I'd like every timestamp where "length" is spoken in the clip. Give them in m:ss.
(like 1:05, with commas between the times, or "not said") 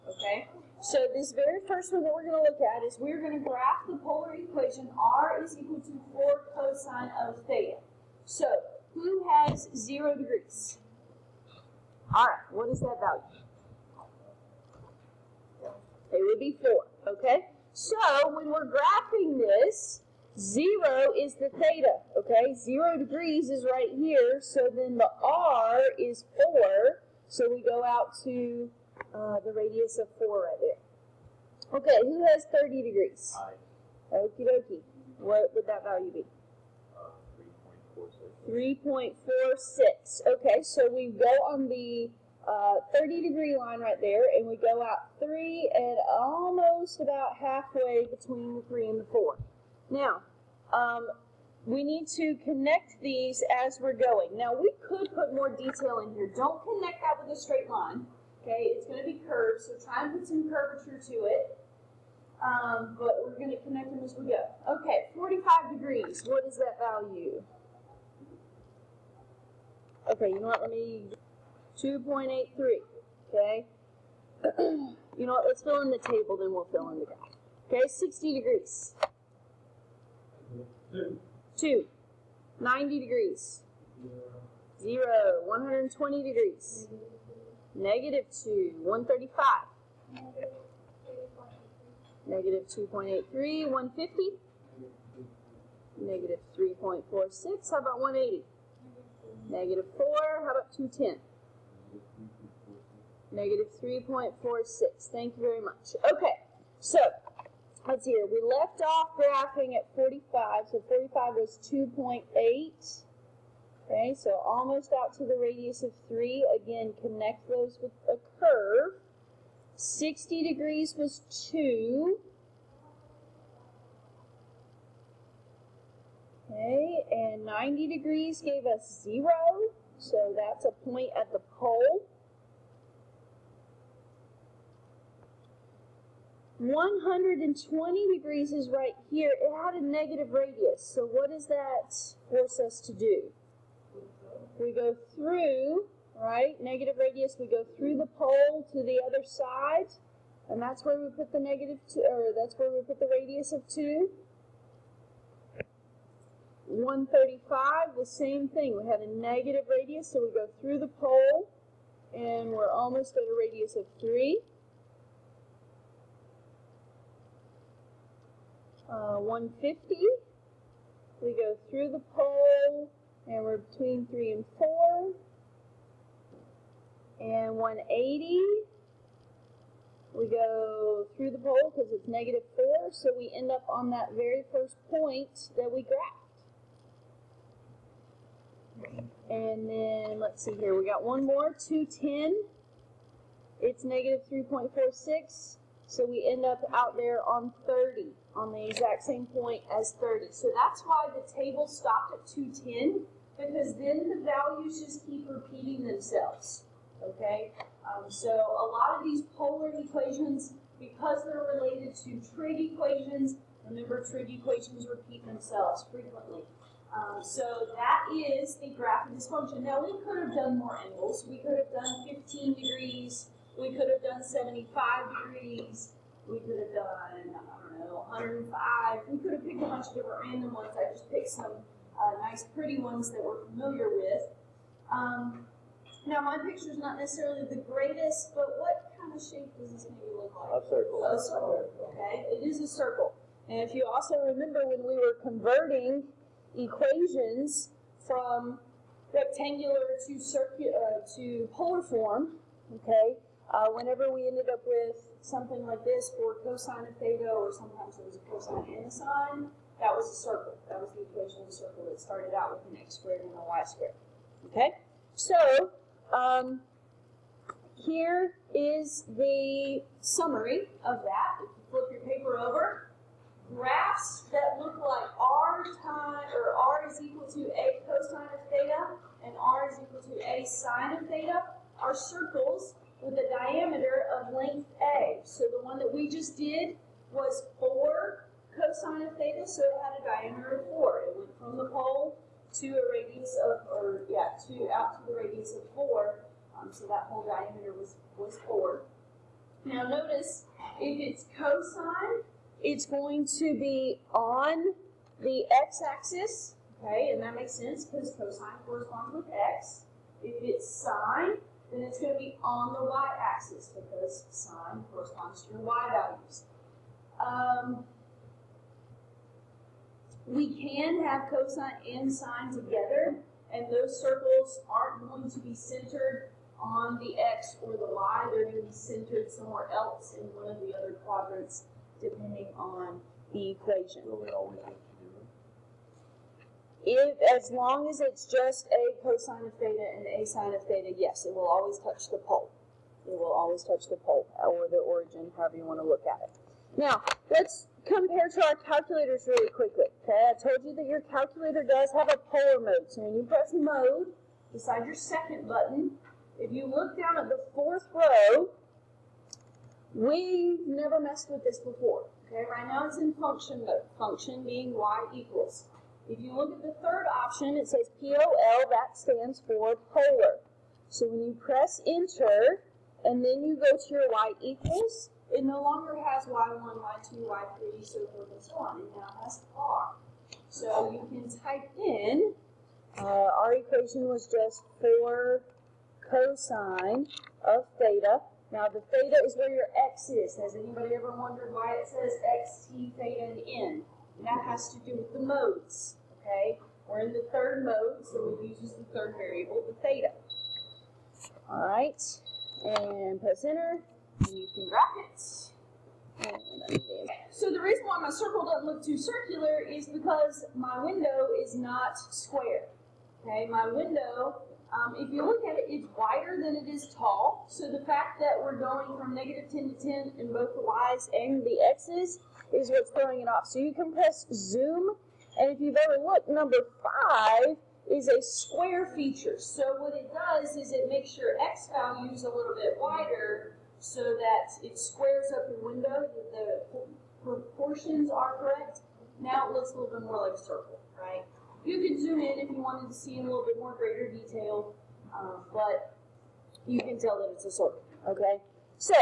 4:44.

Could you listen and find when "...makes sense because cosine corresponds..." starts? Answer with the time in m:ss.
5:07.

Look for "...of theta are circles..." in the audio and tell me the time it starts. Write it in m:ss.
4:40.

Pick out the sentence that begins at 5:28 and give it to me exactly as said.
They're going to be centered somewhere else in one of the other quadrants, depending on the equation.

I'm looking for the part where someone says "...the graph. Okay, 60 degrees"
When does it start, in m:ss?
1:16.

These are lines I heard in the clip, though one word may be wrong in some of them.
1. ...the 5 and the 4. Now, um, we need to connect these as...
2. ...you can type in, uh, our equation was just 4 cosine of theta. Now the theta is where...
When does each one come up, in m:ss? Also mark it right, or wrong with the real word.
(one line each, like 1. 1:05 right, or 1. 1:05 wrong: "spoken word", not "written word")
1. 0:48 wrong: "3", not "5"
2. 6:20 right.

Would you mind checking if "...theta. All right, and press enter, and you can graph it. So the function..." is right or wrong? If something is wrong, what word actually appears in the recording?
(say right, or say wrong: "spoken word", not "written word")
wrong: "reason", not "function".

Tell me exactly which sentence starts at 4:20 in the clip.
That was the equation of a circle.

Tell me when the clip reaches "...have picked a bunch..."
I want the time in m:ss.
3:49.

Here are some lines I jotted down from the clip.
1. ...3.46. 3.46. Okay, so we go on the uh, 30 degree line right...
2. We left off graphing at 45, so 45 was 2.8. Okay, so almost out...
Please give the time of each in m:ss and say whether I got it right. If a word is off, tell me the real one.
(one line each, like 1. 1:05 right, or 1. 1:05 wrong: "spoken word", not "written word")
1. 0:38 right
2. 1:48 right.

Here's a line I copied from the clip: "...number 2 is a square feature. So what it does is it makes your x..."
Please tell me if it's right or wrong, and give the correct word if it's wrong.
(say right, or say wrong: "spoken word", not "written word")
wrong: "5", not "2".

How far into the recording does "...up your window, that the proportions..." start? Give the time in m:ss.
7:15.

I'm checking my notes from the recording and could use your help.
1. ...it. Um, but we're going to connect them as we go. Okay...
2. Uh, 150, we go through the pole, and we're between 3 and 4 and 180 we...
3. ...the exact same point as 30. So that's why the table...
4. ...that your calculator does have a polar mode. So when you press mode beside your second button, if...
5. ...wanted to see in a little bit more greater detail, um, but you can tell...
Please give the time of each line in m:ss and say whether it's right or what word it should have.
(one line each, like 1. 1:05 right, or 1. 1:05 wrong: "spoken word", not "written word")
1. 1:01 right
2. 2:48 right
3. 3:18 right
4. 5:50 right
5. 7:22 right.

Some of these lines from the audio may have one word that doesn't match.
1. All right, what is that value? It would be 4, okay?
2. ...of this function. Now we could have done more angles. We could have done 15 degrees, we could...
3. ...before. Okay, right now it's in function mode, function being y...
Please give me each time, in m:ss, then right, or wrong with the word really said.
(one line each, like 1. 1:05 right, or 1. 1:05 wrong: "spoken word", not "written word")
1. 0:12 right
2. 3:39 right
3. 6:01 right.